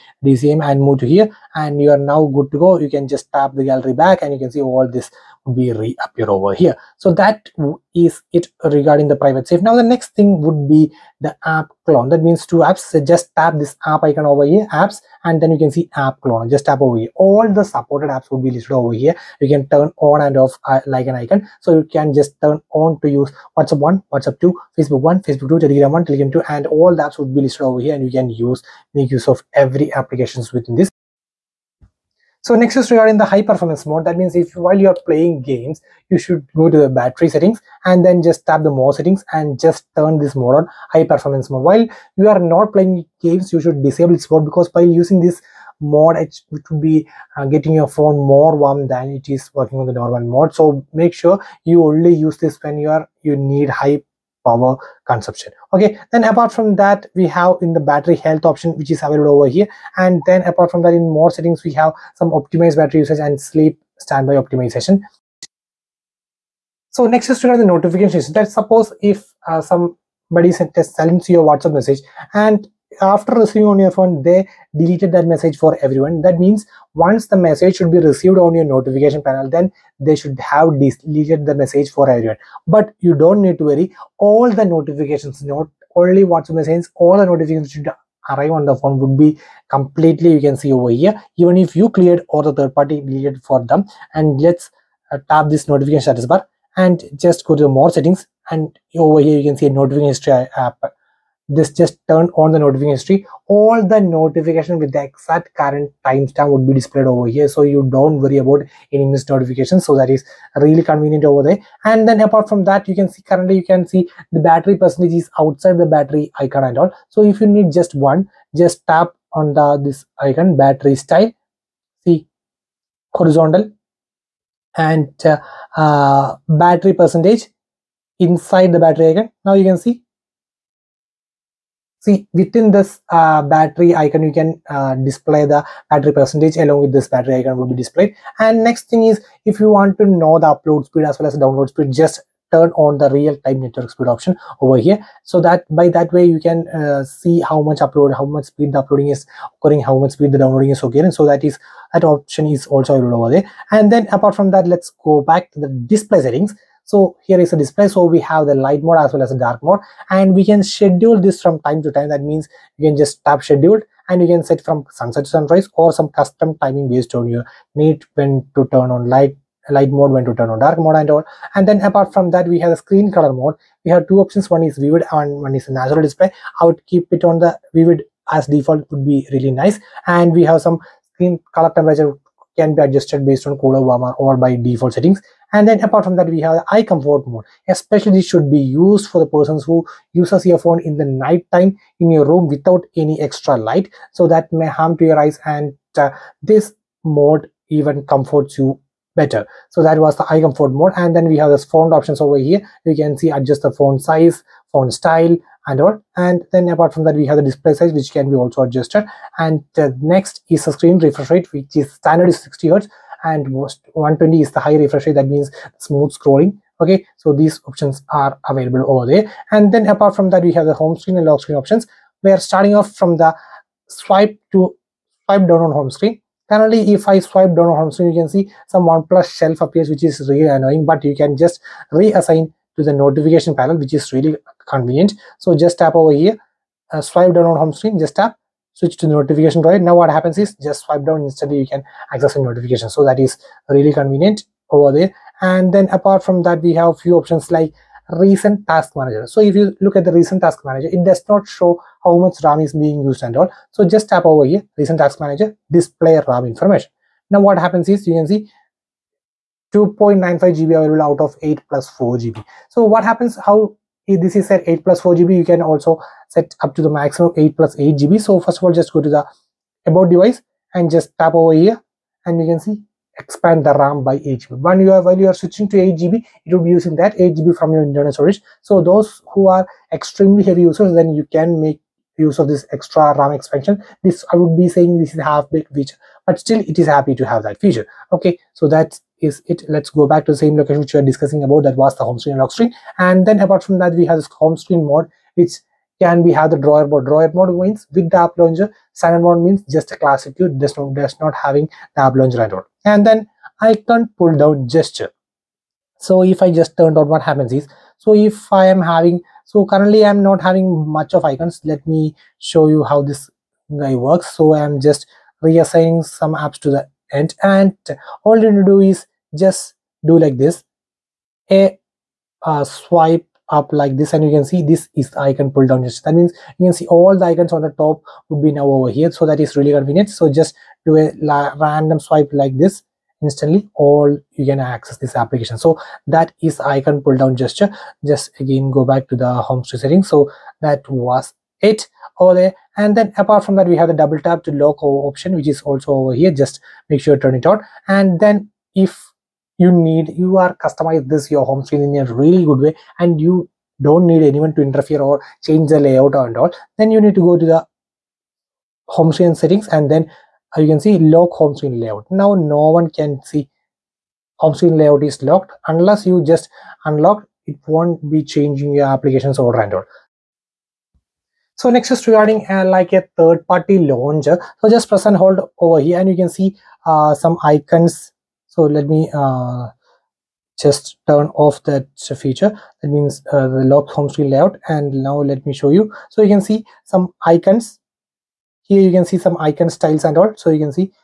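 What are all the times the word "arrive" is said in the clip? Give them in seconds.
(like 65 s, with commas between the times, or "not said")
88 s.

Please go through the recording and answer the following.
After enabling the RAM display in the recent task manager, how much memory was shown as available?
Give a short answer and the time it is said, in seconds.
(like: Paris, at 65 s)
2.95 GB, at 259 s.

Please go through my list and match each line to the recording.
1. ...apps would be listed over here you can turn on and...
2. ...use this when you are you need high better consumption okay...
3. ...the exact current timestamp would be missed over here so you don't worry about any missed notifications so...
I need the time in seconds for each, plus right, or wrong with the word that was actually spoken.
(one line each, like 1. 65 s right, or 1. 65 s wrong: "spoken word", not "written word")
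1. 18 s right
2. 52 s wrong: "power", not "better"
3. 104 s wrong: "displayed", not "missed".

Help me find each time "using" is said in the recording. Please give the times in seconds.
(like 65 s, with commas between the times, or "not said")
44 s, 276 s.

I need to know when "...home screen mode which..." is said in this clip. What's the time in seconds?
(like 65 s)
294 s.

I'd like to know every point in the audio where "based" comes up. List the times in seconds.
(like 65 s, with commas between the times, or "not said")
166 s, 183 s.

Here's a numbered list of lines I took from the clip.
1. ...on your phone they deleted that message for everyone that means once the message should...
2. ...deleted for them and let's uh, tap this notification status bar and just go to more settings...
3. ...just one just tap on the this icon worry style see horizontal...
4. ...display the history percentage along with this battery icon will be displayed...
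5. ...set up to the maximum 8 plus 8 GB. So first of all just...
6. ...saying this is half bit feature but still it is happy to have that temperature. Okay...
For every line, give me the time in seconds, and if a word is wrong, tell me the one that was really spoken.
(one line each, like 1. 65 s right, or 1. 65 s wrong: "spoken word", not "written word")
1. 73 s right
2. 92 s right
3. 117 s wrong: "battery", not "worry"
4. 134 s wrong: "battery", not "history"
5. 266 s right
6. 284 s wrong: "feature", not "temperature".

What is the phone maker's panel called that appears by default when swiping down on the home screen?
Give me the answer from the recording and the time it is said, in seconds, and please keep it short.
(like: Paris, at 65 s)
OnePlus shelf, at 228 s.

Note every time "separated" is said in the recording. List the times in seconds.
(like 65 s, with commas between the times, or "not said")
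not said.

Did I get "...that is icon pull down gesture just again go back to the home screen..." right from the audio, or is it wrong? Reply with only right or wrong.
right.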